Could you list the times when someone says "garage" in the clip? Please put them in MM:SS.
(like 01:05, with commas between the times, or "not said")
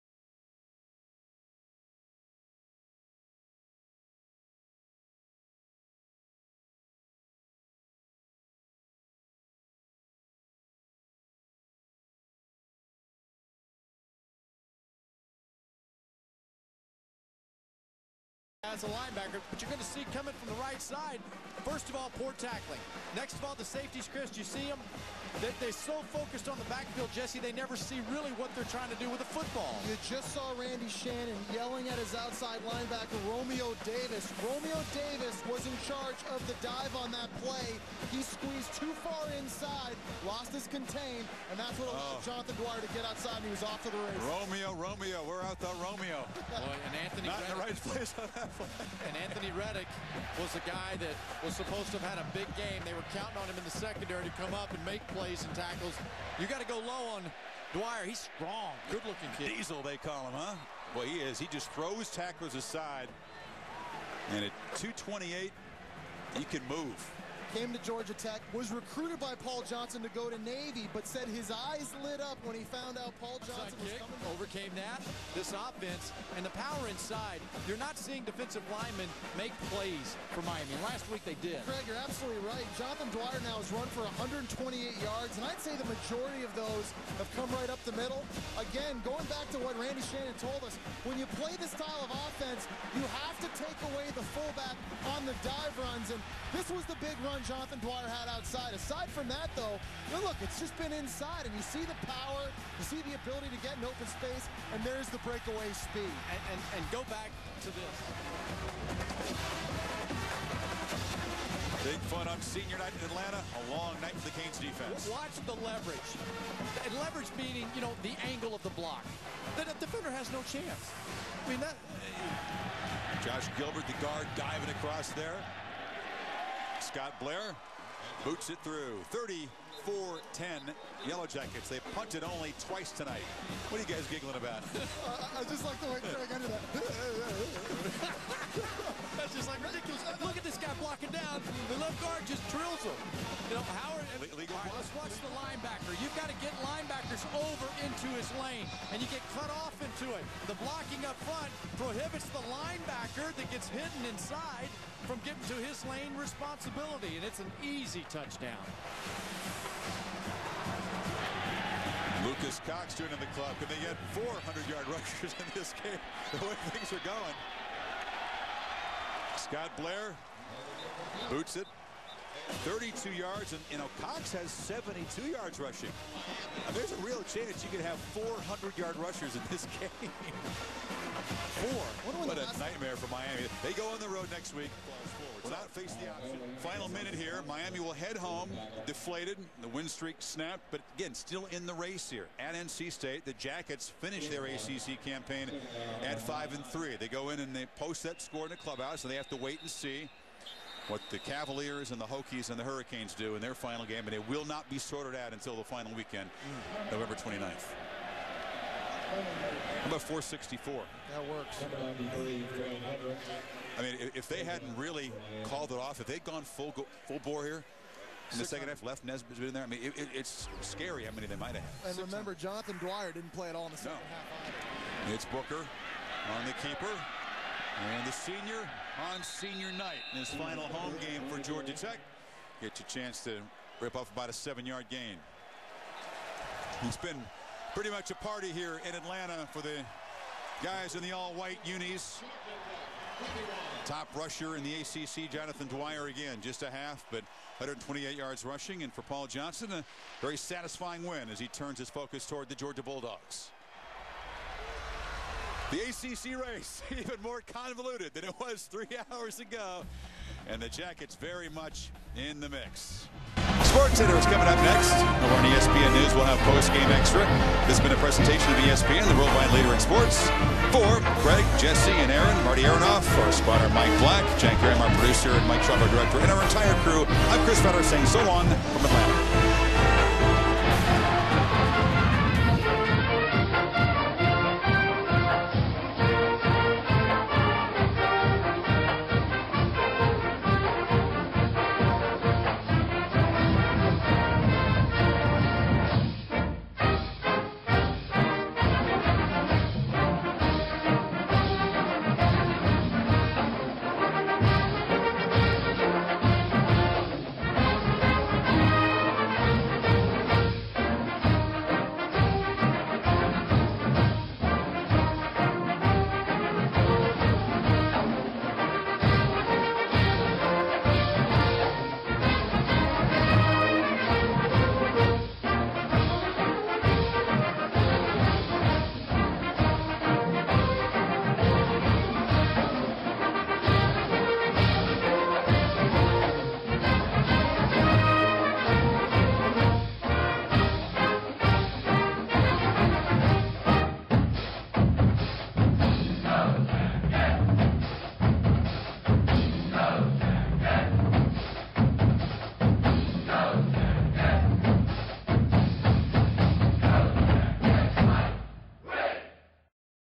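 not said.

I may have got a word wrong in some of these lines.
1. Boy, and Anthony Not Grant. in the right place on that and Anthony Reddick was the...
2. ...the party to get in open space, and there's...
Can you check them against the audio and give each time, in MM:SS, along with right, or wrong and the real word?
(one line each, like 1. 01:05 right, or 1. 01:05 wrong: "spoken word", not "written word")
1. 00:46 right
2. 01:43 wrong: "ability", not "party".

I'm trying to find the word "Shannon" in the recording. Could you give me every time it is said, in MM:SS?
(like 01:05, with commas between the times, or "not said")
00:30, 01:30.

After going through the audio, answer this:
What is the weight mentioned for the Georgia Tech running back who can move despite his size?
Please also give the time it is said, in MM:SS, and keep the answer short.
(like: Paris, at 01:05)
228, at 01:04.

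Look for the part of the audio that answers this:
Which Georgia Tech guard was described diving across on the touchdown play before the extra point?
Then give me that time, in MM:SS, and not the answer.
02:03.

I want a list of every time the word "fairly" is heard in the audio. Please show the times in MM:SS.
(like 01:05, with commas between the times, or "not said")
not said.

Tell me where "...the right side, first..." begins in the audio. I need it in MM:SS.
00:20.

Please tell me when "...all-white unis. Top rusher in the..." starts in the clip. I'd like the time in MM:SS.
04:01.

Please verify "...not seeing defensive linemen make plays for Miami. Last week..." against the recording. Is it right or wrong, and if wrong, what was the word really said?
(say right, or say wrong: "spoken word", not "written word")
right.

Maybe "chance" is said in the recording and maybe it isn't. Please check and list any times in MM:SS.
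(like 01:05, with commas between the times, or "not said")
02:00, 02:57, 03:52.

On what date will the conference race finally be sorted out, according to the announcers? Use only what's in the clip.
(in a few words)
November 29th.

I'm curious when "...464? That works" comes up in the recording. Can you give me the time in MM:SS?
03:30.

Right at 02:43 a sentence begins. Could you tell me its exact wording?
Can they get 400-yard rushers in this game?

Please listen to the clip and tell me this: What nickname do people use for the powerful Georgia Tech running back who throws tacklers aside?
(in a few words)
Diesel.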